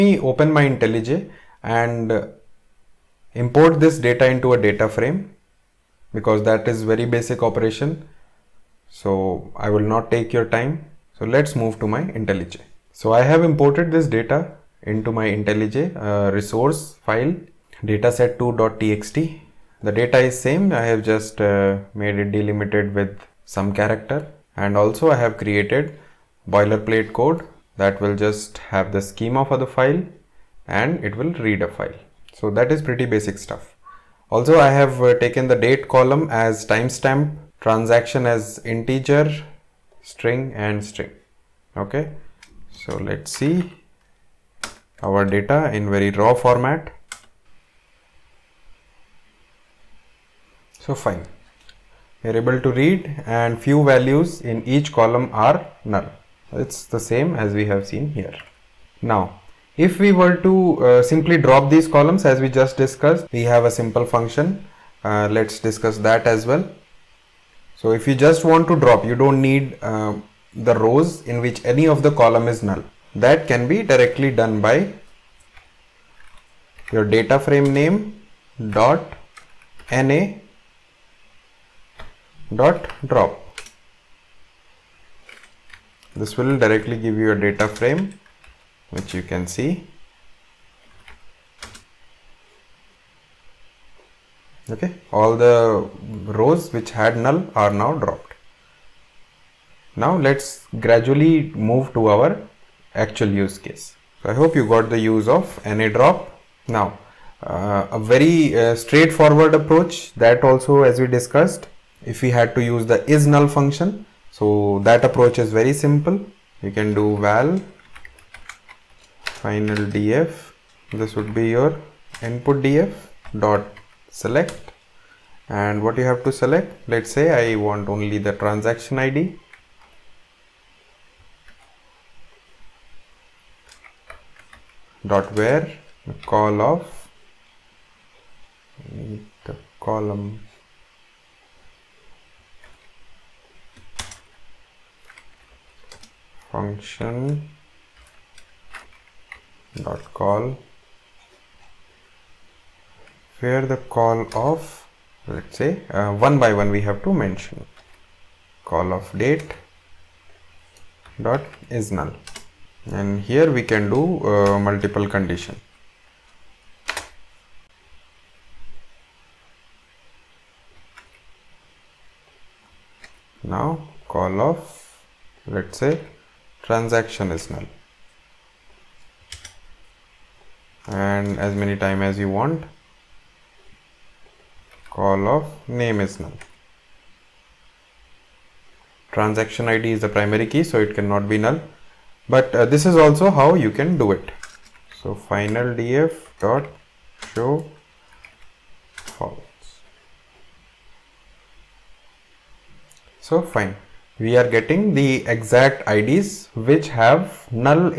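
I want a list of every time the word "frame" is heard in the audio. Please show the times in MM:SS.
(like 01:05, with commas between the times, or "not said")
00:04, 01:17, 01:27.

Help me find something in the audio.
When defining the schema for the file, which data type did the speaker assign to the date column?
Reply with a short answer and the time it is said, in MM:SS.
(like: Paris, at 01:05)
timestamp, at 00:36.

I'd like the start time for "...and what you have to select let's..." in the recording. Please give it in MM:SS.
02:05.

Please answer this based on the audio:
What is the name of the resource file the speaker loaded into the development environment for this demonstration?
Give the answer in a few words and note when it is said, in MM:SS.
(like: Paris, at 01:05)
dataset2.txt, at 00:17.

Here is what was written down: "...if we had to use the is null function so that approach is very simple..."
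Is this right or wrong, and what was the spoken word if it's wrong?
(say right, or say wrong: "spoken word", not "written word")
right.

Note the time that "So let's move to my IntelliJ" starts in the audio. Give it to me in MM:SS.
00:11.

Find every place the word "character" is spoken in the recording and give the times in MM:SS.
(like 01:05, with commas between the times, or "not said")
00:23.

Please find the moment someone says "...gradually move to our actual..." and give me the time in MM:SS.
01:40.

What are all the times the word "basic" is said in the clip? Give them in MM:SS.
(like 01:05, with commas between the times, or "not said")
00:07, 00:33.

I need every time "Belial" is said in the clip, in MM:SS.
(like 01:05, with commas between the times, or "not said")
not said.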